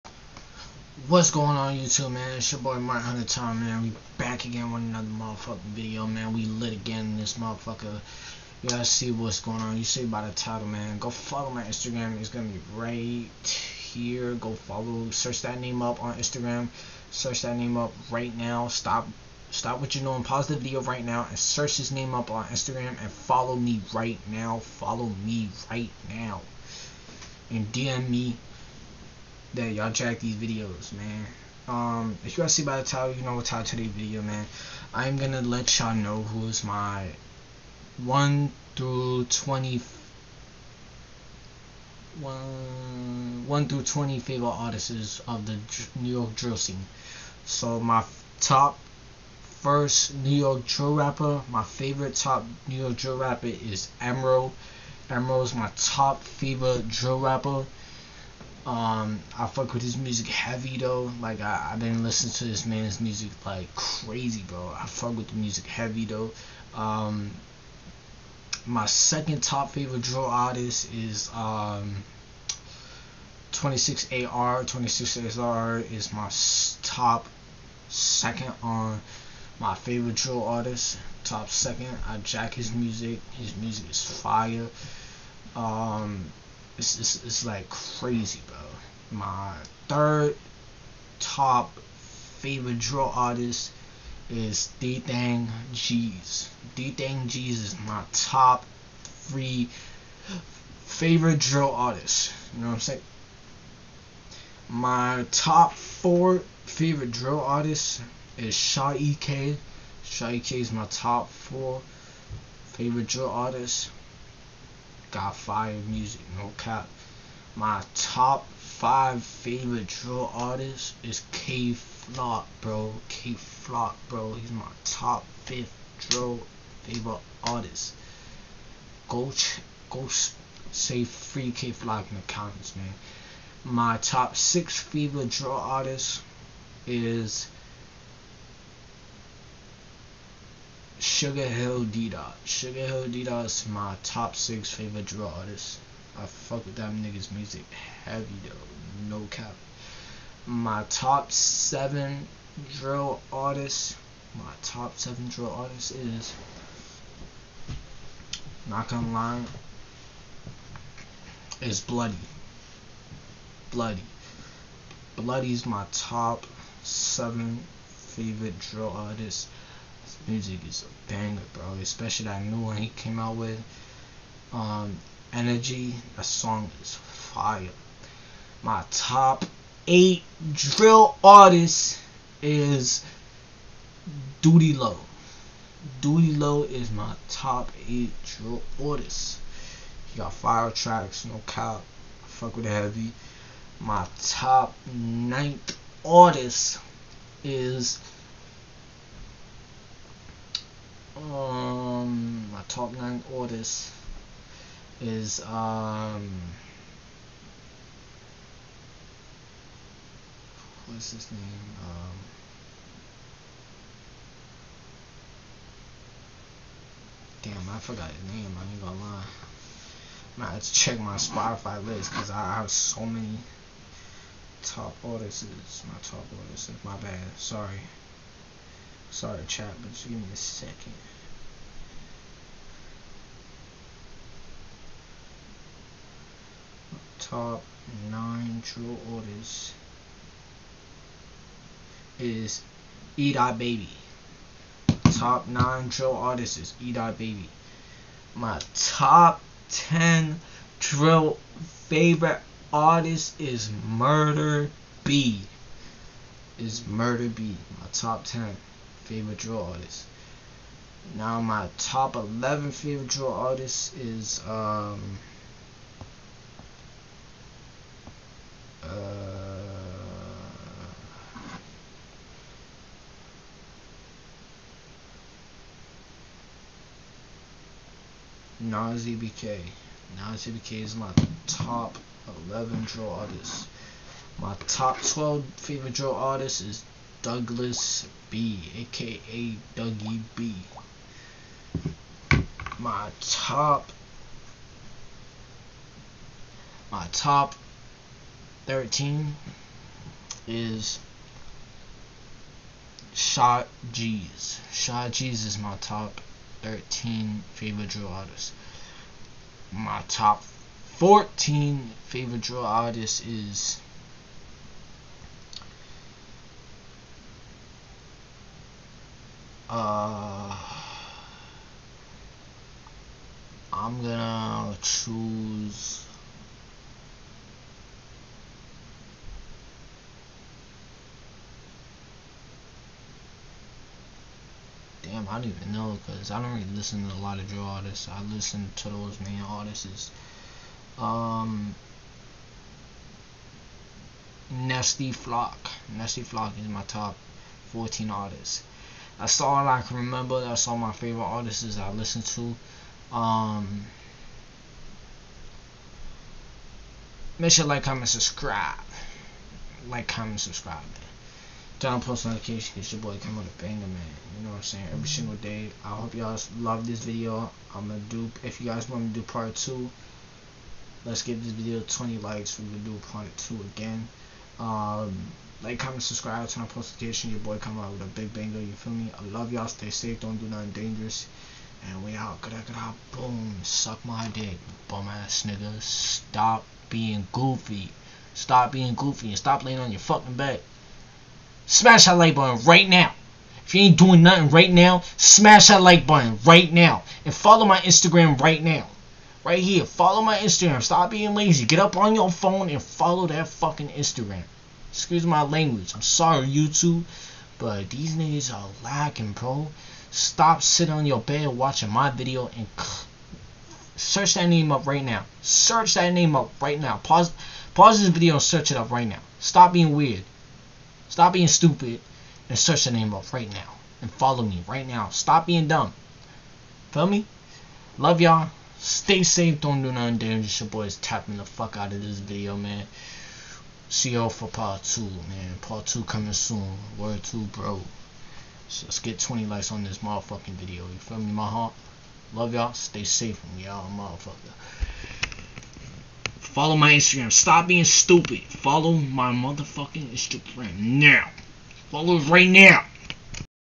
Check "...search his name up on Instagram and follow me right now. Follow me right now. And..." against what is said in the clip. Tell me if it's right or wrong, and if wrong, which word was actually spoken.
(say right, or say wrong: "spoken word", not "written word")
right.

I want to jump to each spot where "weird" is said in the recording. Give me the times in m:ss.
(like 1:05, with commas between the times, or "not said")
6:59.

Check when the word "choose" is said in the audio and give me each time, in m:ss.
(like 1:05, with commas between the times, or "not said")
5:24.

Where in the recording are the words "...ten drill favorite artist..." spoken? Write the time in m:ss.
4:09.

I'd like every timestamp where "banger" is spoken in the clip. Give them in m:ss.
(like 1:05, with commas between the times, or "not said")
2:51, 6:03, 6:18.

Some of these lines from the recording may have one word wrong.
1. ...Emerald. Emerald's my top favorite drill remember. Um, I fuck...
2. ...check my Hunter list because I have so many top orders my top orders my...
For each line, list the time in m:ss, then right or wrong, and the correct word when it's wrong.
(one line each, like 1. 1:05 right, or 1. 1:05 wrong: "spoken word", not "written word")
1. 0:54 wrong: "rapper", not "remember"
2. 3:40 wrong: "Spotify", not "Hunter".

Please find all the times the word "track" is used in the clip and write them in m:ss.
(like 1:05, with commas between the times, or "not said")
0:29, 3:10.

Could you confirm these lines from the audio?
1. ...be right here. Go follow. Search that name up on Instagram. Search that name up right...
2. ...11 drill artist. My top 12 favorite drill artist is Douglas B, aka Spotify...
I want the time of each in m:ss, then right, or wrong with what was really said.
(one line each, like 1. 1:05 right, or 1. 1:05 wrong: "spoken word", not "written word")
1. 0:12 right
2. 4:42 wrong: "Dougie", not "Spotify".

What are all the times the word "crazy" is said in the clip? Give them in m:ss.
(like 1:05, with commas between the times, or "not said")
1:03, 1:27.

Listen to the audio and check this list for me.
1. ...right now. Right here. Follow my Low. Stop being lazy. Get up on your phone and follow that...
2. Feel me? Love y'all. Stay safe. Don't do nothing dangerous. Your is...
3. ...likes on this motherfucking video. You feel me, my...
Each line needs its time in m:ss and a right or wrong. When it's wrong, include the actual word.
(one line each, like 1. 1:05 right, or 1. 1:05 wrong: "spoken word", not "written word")
1. 6:38 wrong: "Instagram", not "Low"
2. 7:06 right
3. 7:19 right.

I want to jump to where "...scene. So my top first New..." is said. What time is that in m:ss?
0:46.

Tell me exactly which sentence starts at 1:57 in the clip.
My top five favorite drill artists is Kay Flock, bro.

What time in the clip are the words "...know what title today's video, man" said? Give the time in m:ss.
0:33.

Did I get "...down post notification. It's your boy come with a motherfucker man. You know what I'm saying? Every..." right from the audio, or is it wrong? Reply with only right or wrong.
wrong.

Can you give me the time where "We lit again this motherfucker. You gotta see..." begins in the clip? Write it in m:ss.
0:06.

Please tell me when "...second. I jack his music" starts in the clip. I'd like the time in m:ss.
1:21.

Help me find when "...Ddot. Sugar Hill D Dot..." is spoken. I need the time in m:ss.
2:21.